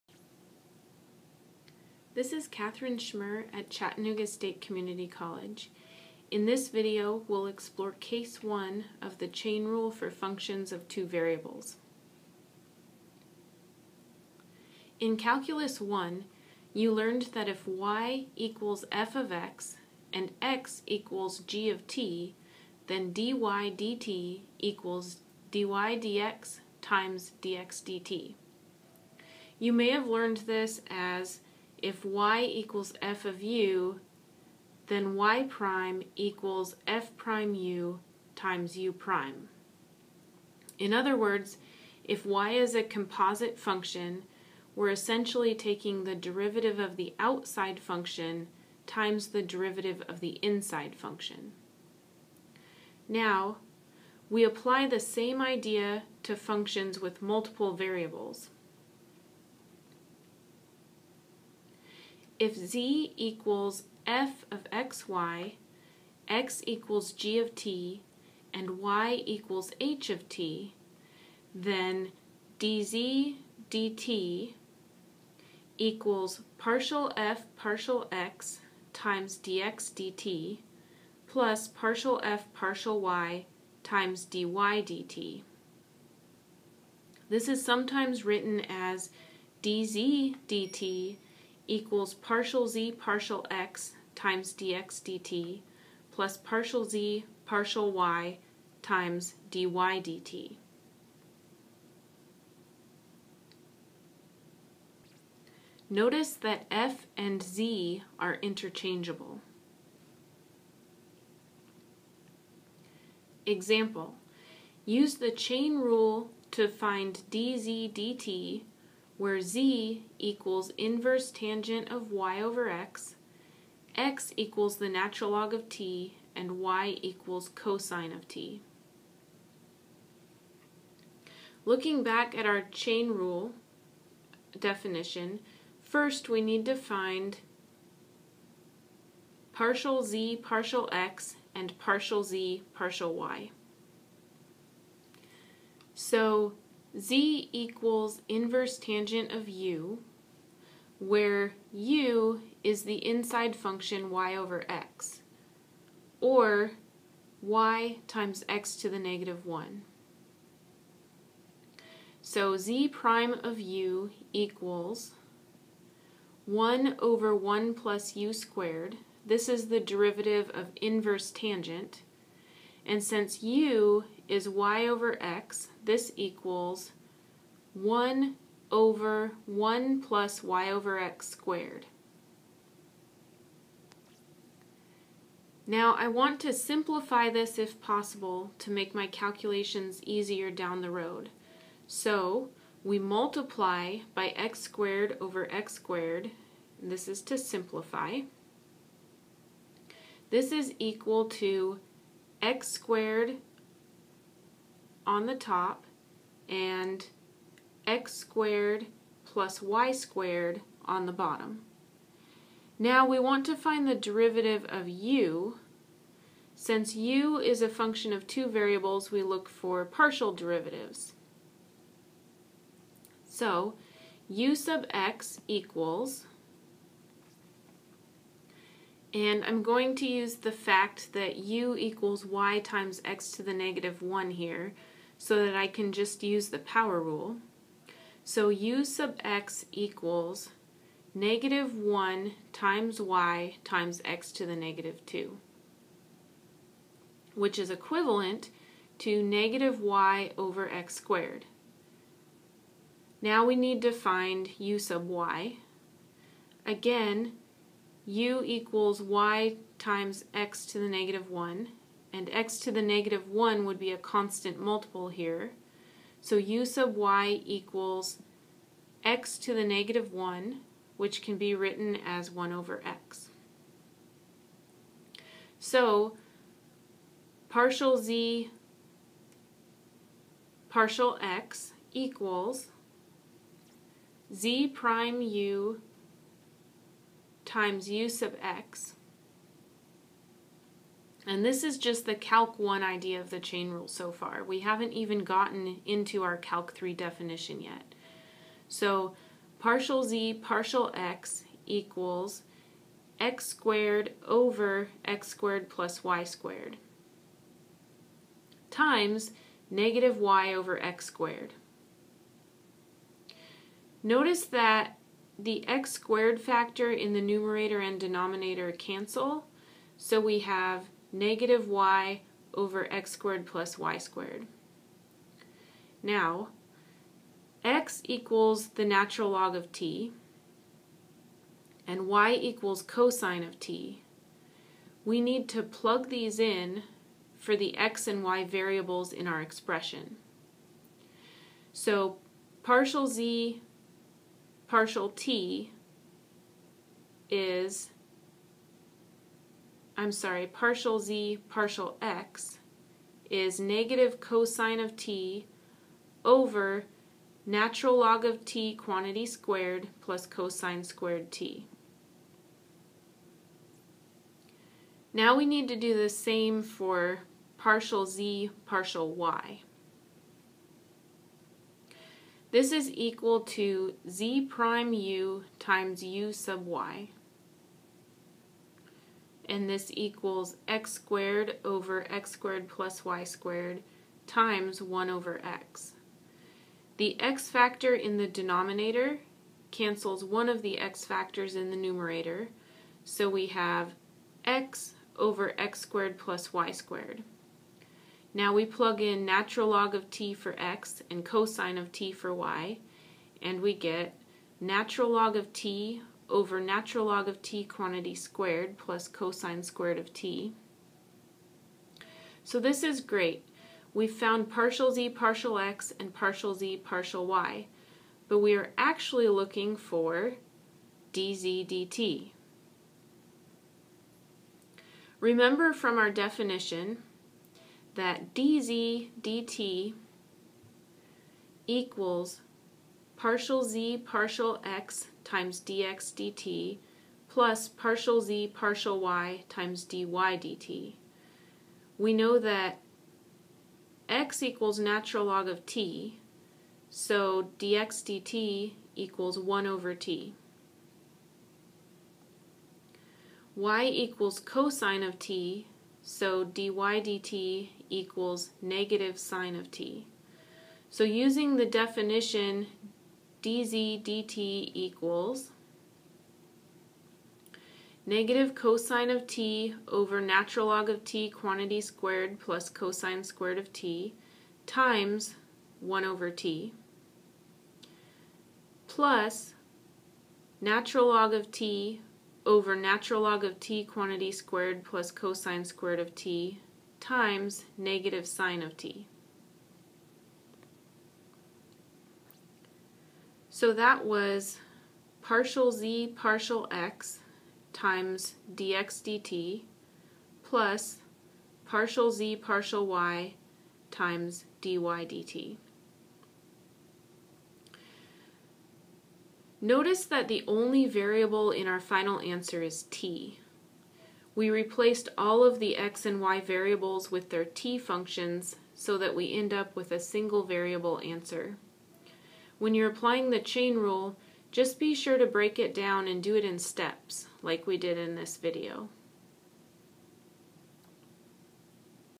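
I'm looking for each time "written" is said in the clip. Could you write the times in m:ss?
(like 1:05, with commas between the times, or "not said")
1:28, 4:31.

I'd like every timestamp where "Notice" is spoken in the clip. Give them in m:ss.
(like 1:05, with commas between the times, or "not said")
1:45, 5:14, 8:29.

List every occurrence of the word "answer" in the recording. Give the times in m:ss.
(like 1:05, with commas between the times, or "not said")
8:32, 8:41.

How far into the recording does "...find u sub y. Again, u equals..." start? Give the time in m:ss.
4:13.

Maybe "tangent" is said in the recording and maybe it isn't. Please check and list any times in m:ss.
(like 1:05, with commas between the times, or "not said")
2:01, 2:28, 2:51.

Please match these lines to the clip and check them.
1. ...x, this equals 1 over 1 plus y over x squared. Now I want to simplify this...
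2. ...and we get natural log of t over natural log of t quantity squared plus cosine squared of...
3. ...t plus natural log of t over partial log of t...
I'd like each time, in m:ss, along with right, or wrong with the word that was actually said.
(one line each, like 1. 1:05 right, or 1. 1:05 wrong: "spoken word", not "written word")
1. 2:55 right
2. 6:43 right
3. 7:56 wrong: "natural", not "partial".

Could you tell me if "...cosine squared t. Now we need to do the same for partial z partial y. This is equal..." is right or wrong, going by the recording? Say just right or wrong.
right.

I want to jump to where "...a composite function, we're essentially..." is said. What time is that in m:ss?
0:42.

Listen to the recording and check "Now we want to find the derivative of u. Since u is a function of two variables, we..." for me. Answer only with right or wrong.
right.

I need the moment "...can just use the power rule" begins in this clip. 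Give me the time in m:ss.
3:55.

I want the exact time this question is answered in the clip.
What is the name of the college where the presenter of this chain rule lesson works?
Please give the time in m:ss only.
0:03.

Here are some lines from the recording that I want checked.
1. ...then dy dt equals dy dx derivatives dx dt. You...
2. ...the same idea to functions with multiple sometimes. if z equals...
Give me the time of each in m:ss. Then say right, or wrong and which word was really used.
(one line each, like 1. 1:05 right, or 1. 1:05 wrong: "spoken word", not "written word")
1. 0:22 wrong: "times", not "derivatives"
2. 0:54 wrong: "variables", not "sometimes".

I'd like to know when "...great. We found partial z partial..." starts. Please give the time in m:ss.
6:53.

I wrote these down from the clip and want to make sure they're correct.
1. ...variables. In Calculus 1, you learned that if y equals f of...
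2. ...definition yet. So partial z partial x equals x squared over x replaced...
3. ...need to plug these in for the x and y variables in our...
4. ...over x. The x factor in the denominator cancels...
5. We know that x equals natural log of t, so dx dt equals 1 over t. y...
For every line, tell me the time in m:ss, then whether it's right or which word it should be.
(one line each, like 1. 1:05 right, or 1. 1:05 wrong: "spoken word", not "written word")
1. 0:11 right
2. 4:56 wrong: "squared", not "replaced"
3. 5:35 right
4. 6:25 right
5. 7:21 right.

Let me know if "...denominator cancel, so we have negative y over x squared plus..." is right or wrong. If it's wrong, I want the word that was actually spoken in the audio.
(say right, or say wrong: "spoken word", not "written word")
right.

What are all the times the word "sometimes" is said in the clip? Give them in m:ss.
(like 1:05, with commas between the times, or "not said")
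1:27.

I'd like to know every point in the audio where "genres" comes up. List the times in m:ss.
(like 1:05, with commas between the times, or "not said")
not said.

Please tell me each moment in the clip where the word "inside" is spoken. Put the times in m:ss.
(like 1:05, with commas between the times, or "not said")
0:50, 2:33.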